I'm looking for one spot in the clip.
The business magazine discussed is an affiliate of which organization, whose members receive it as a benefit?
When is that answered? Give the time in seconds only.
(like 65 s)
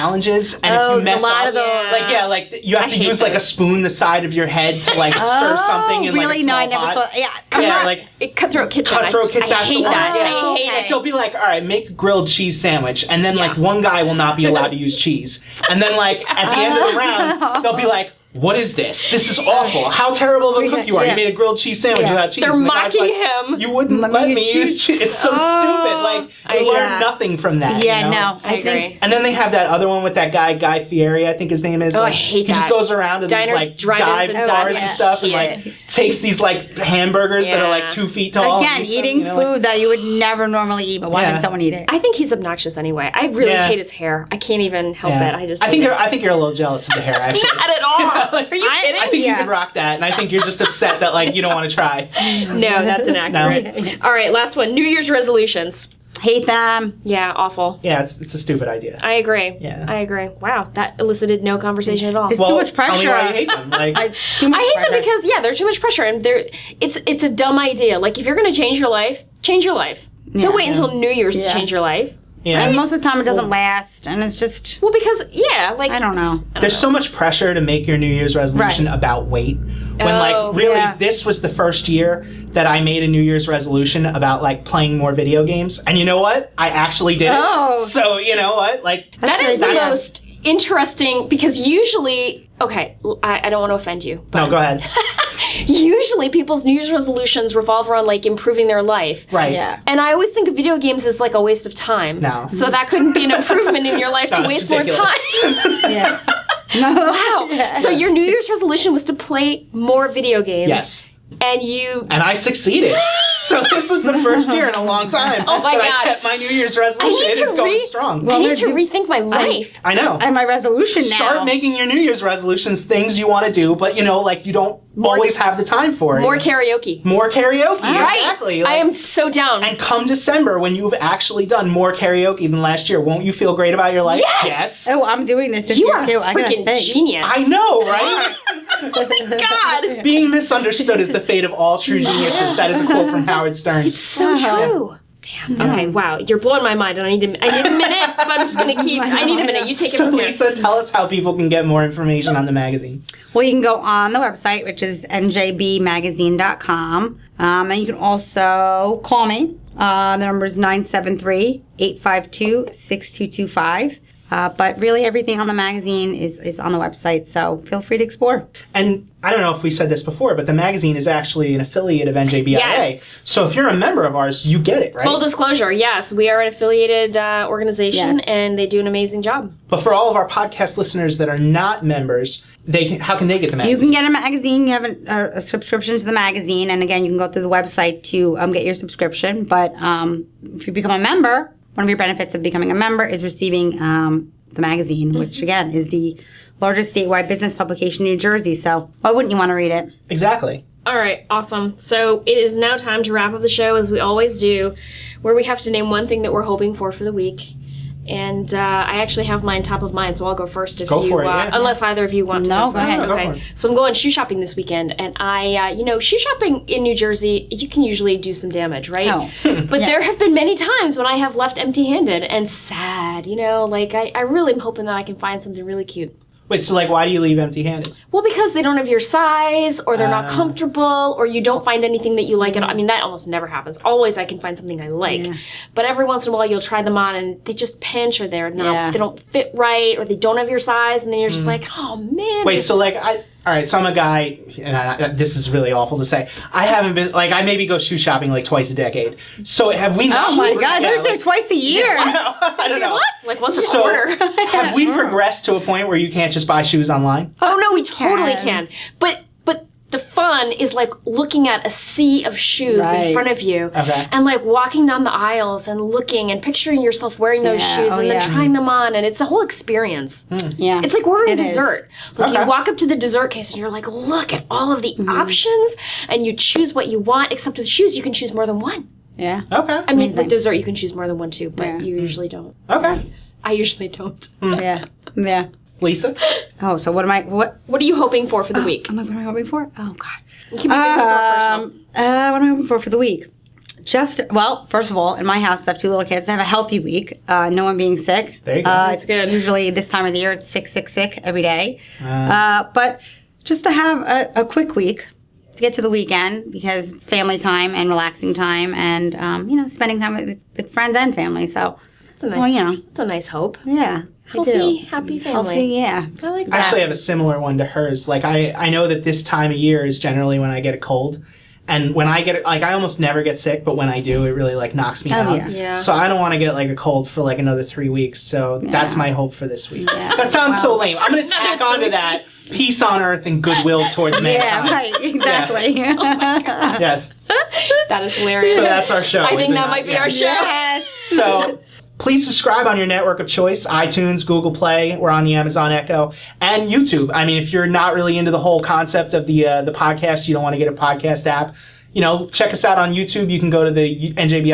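172 s.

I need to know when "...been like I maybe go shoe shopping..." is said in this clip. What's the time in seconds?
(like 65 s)
246 s.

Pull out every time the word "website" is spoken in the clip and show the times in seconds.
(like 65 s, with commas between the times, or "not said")
154 s, 166 s, 187 s.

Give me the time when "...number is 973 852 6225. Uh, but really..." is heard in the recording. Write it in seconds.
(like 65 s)
160 s.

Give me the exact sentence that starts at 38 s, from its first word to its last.
Again, eating stuff, you know, food like, that you would never normally eat, but watching someone eat it.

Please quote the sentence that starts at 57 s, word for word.
Yeah, it's, it's a stupid idea.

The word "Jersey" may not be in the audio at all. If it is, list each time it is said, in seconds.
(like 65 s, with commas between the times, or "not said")
198 s, 216 s.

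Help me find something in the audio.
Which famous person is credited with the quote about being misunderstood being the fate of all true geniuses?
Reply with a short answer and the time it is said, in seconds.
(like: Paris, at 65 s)
Howard Stern, at 143 s.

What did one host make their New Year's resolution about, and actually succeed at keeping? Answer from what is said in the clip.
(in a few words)
Playing more video games.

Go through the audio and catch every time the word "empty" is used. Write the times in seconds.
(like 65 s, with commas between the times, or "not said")
221 s, 227 s.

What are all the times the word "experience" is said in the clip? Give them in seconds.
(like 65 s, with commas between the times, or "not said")
269 s.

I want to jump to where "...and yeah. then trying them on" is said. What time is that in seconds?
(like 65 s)
267 s.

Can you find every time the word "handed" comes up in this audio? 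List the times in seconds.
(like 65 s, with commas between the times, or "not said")
221 s, 227 s.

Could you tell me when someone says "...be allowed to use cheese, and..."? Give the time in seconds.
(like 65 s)
14 s.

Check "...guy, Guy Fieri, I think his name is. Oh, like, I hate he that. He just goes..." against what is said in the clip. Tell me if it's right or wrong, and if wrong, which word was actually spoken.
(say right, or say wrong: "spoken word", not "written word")
right.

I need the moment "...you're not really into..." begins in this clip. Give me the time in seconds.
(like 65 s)
347 s.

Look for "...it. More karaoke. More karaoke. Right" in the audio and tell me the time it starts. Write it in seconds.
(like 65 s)
126 s.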